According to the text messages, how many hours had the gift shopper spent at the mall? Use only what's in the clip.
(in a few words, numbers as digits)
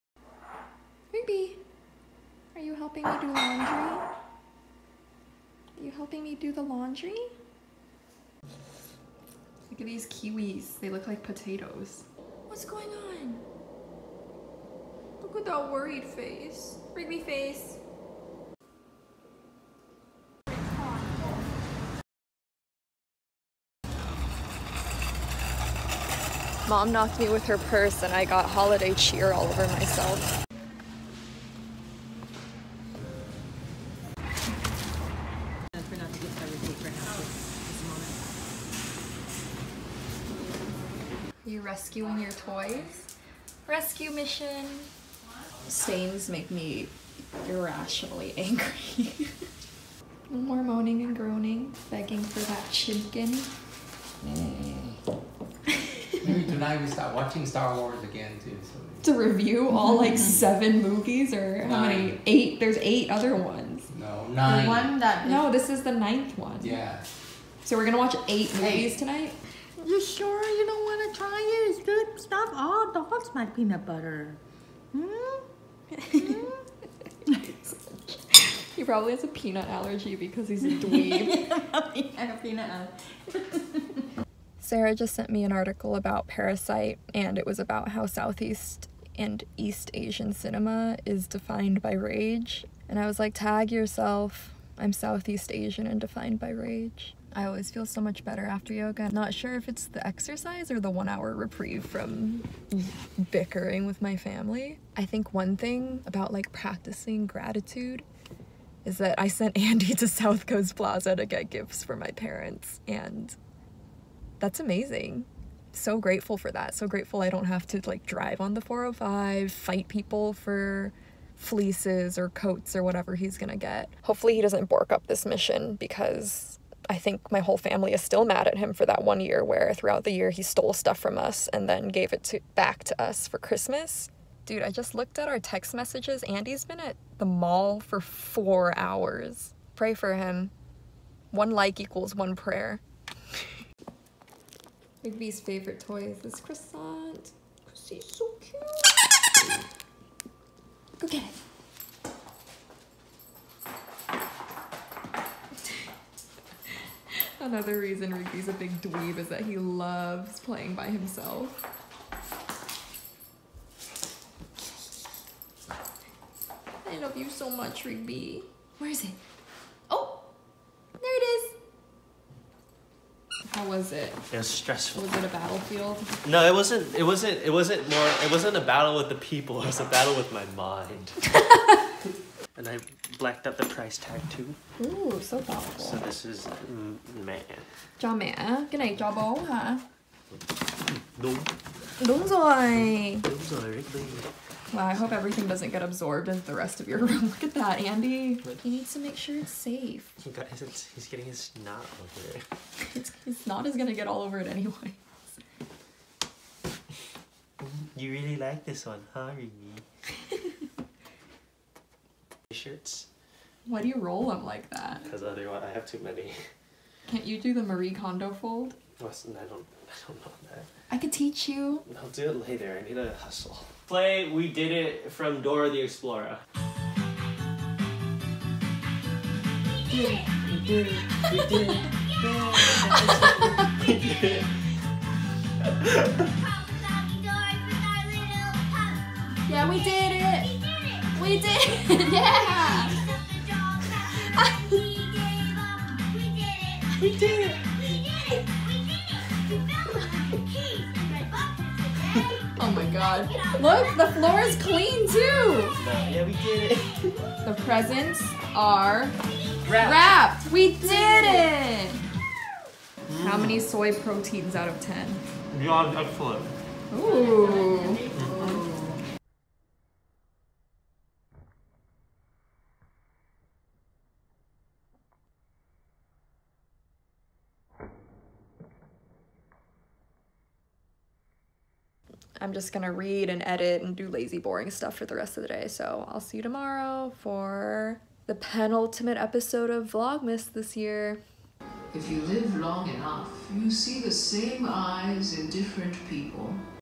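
4.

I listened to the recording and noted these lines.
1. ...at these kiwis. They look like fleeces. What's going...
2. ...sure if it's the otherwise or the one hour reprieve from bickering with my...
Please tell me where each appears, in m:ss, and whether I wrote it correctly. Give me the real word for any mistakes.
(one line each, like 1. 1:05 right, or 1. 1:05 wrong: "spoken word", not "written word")
1. 0:09 wrong: "potatoes", not "fleeces"
2. 1:39 wrong: "exercise", not "otherwise".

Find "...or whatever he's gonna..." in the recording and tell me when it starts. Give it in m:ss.
2:02.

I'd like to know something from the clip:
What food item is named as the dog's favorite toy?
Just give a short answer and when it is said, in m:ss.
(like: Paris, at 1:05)
Croissant, at 2:26.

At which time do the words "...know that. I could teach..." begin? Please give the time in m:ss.
3:40.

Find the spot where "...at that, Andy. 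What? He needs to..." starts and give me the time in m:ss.
3:17.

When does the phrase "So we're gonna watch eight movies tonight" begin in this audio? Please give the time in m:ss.
1:07.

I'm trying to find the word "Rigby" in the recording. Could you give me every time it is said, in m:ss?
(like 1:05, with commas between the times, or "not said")
0:16, 2:25, 2:38, 2:47, 3:13, 3:29.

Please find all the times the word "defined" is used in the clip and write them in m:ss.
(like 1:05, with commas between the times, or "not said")
1:31, 1:35.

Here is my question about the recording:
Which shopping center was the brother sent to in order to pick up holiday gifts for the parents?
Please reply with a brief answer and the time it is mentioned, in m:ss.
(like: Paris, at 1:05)
South Coast Plaza, at 1:50.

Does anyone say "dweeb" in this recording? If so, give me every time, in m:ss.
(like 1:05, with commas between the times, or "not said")
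1:20, 2:38.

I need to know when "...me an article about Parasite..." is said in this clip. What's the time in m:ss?
1:25.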